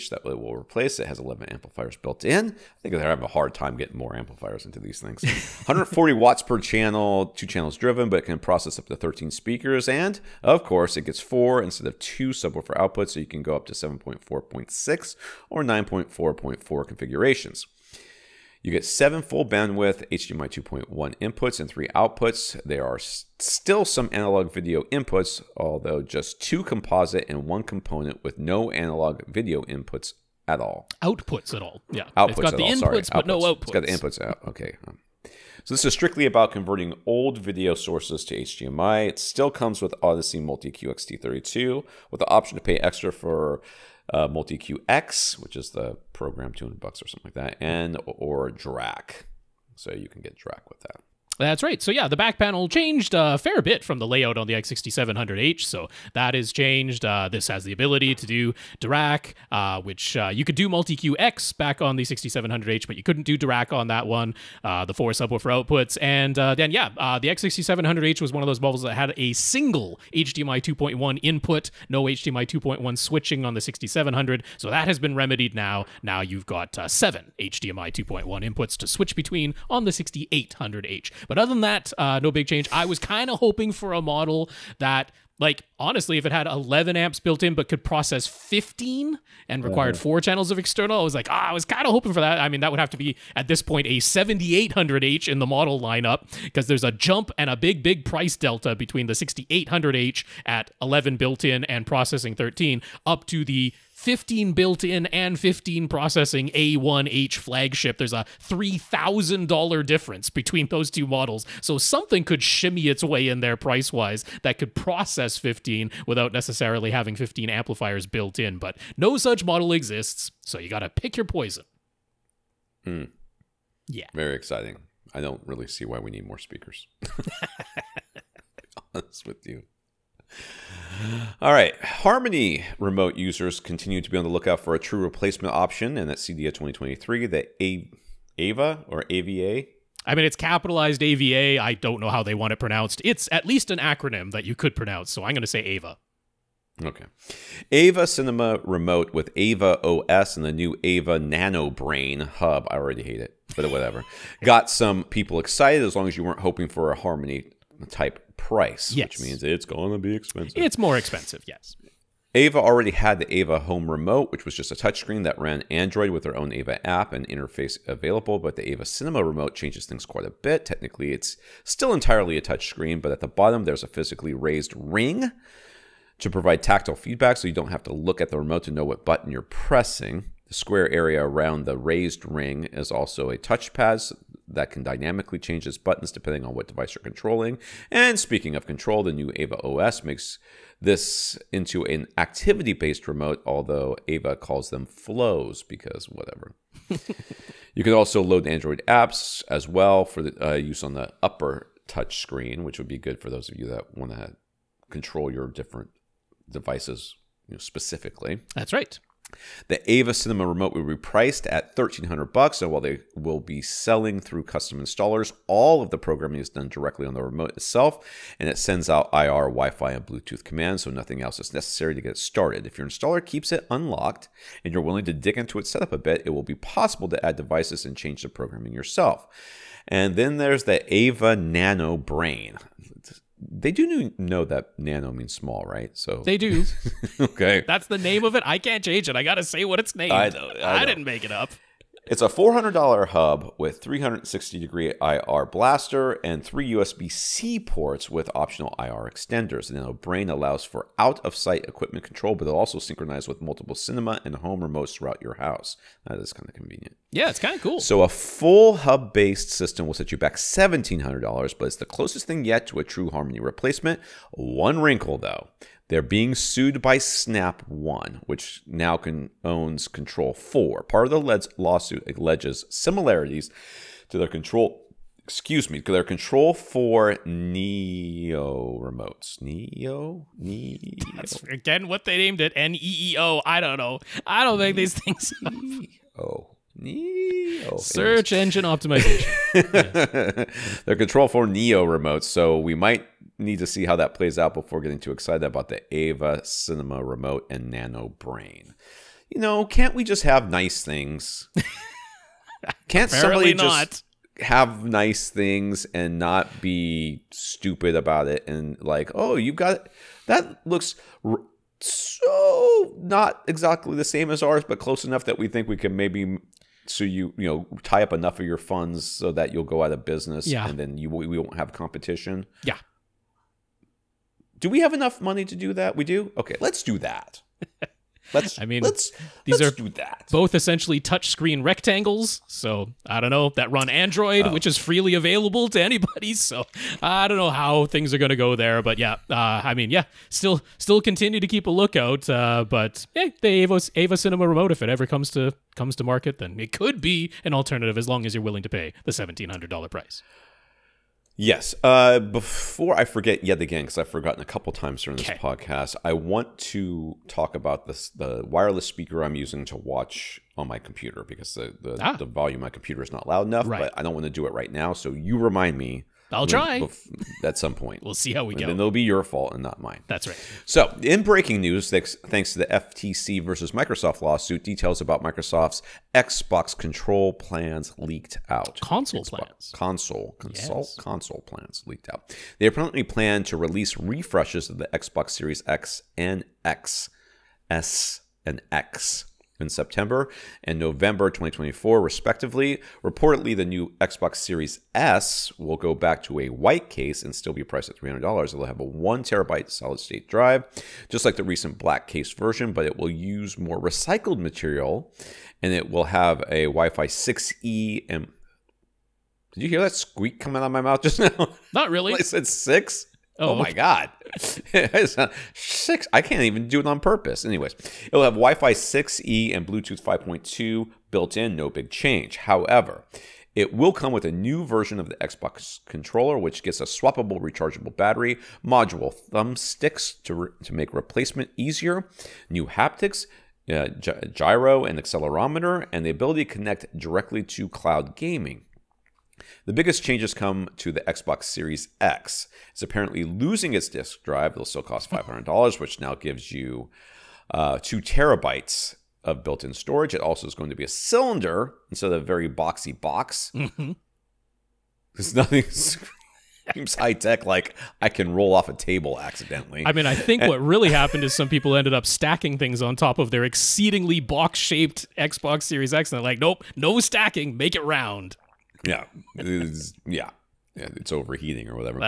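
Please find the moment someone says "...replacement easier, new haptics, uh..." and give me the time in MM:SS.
07:10.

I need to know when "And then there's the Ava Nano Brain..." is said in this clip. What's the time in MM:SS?
03:49.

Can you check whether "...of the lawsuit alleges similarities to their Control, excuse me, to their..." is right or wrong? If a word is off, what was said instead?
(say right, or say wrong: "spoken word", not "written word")
right.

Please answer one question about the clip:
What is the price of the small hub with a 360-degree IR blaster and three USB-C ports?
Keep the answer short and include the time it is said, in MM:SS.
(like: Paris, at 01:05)
$400, at 04:02.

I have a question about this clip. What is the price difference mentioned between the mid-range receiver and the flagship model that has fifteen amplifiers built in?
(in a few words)
$3,000.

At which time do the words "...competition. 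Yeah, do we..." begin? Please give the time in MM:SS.
05:21.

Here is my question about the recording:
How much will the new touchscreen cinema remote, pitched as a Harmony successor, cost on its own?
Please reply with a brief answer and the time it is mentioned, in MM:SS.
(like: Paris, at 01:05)
$1,300, at 03:31.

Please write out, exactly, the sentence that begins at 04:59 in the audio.
You know, can't we just have nice things?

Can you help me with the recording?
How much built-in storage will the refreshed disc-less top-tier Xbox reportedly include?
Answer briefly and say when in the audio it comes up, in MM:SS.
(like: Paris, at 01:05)
2 terabytes, at 07:27.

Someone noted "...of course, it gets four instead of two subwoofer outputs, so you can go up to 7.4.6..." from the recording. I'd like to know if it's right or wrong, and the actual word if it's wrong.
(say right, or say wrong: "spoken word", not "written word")
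right.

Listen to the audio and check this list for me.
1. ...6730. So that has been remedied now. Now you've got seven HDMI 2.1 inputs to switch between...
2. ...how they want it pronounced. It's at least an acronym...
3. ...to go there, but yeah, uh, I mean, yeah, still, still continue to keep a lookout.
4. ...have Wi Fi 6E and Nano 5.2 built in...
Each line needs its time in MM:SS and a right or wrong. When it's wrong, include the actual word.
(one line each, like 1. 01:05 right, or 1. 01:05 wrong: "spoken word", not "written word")
1. 01:13 wrong: "6700", not "6730"
2. 02:22 right
3. 05:38 right
4. 06:58 wrong: "Bluetooth", not "Nano".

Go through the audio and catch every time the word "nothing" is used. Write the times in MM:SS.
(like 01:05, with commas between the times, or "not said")
03:40, 07:35.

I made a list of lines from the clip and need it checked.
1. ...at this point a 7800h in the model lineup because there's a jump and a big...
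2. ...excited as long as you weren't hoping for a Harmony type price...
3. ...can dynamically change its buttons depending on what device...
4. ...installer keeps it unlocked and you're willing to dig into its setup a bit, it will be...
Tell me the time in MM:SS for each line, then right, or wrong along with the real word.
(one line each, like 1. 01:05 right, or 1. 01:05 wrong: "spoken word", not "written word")
1. 01:33 right
2. 02:35 right
3. 03:04 right
4. 03:42 right.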